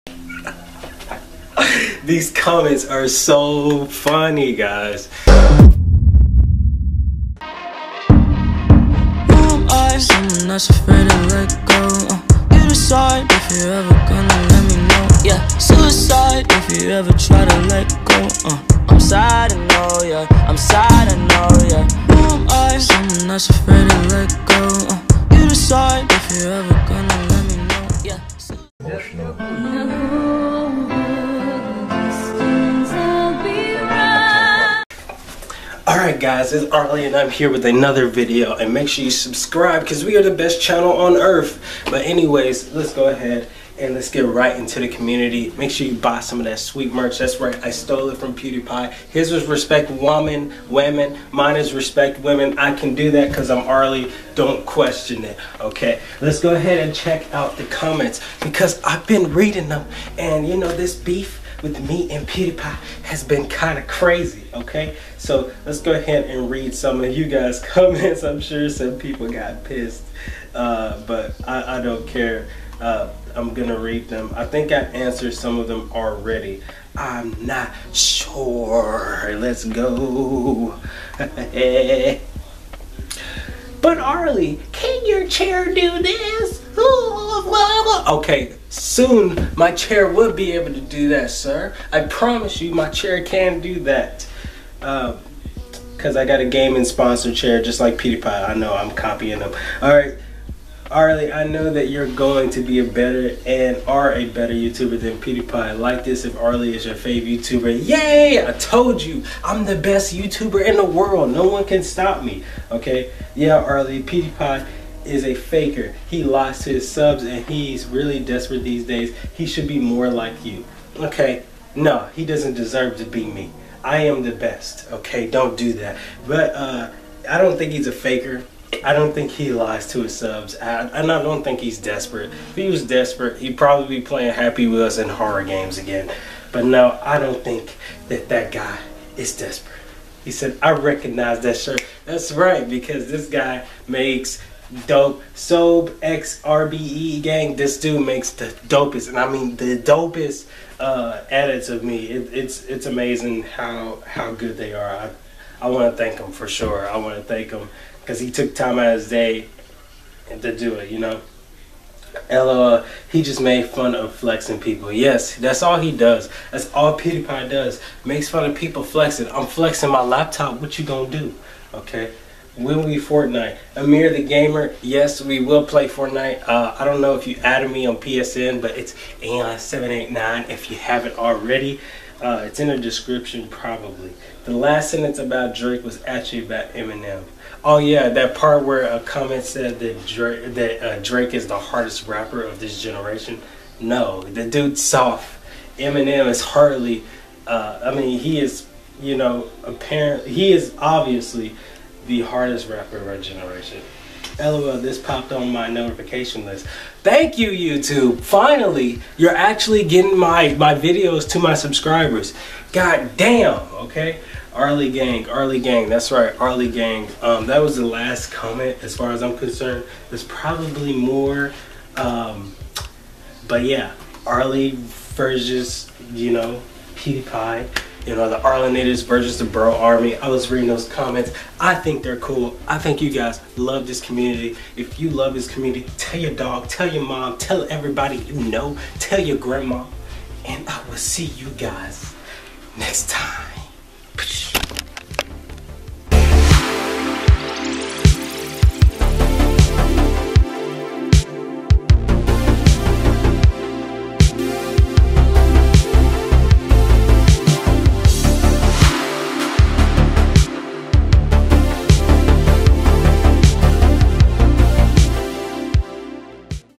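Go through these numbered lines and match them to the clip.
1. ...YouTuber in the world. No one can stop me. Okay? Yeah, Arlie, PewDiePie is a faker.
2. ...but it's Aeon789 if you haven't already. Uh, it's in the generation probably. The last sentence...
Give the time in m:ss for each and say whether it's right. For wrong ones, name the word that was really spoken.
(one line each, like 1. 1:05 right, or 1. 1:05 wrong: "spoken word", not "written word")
1. 1:50 right
2. 2:58 wrong: "description", not "generation".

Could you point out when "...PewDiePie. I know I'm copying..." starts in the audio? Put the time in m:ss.
1:37.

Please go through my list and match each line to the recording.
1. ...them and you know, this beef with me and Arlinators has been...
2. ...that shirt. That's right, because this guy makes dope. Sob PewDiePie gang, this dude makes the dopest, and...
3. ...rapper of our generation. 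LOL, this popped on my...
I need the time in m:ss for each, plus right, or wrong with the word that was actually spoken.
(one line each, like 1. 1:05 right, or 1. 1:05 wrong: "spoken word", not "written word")
1. 0:59 wrong: "PewDiePie", not "Arlinators"
2. 2:21 wrong: "XRBE", not "PewDiePie"
3. 3:22 right.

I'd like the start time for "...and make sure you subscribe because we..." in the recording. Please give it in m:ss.
0:38.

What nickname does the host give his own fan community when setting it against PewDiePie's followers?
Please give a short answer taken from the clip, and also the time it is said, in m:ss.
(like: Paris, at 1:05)
Arlinators, at 3:48.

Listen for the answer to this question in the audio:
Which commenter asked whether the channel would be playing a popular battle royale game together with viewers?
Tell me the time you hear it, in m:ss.
2:53.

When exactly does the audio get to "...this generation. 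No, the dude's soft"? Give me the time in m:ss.
3:12.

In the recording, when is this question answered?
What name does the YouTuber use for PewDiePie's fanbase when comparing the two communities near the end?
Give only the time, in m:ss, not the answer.
3:49.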